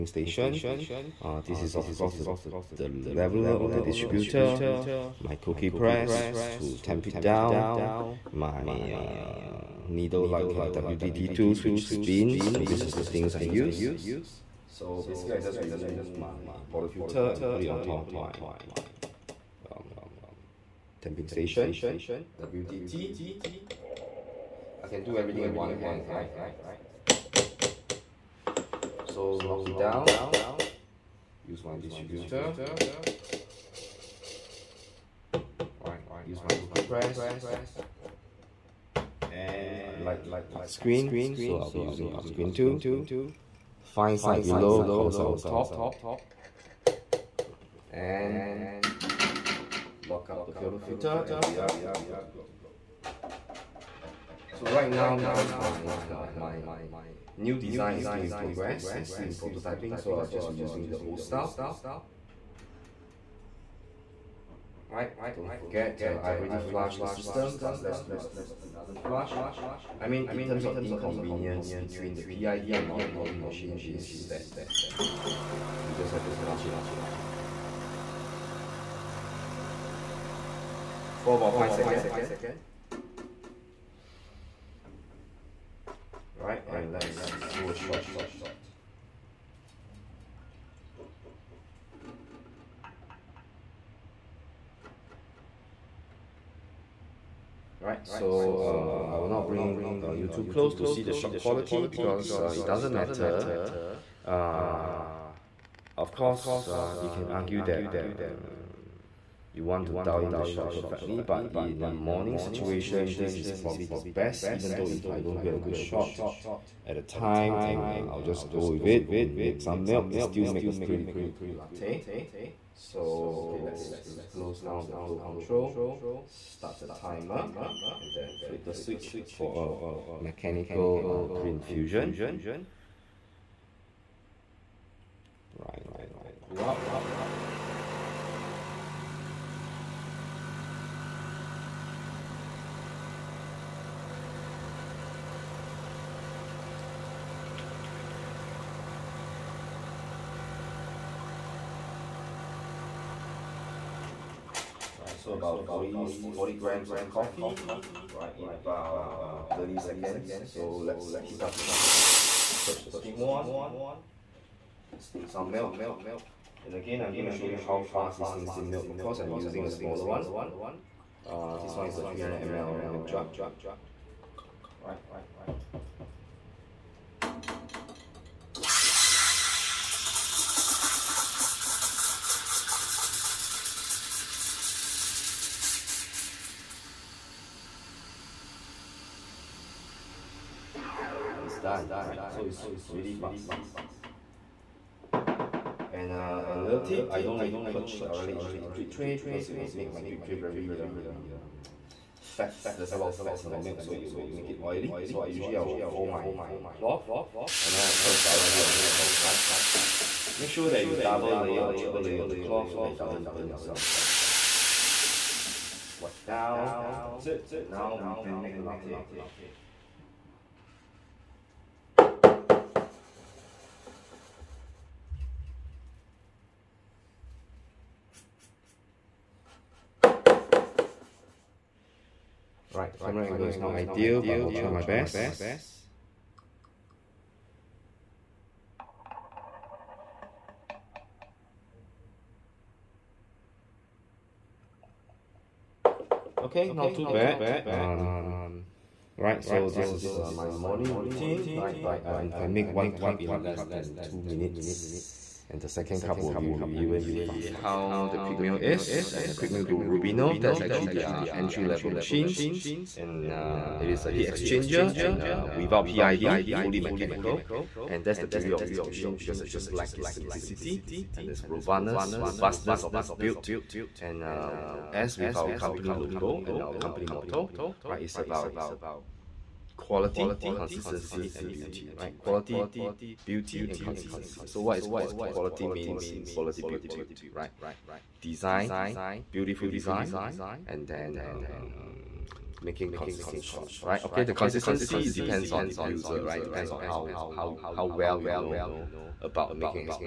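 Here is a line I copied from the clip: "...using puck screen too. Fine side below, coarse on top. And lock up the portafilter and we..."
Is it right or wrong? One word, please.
right.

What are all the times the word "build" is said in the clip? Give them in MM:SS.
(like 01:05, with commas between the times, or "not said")
04:33, 04:46.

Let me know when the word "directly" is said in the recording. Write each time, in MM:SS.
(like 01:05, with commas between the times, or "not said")
03:18, 03:28.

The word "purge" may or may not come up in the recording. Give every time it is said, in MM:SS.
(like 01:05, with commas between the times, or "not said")
03:17, 03:28.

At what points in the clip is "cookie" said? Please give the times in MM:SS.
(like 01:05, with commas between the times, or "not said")
00:05, 00:36.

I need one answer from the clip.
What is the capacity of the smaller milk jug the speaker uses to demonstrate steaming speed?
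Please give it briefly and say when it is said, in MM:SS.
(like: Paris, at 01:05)
300 ml, at 02:52.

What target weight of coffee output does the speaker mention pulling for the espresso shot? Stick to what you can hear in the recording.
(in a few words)
40 grams.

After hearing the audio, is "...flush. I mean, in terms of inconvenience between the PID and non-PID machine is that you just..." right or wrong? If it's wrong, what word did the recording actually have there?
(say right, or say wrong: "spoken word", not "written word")
right.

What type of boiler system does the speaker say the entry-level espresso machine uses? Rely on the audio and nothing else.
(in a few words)
heat exchanger.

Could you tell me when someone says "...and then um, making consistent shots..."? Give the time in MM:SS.
04:50.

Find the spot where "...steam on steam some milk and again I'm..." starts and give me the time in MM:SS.
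02:42.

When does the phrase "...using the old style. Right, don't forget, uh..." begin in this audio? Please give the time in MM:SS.
01:00.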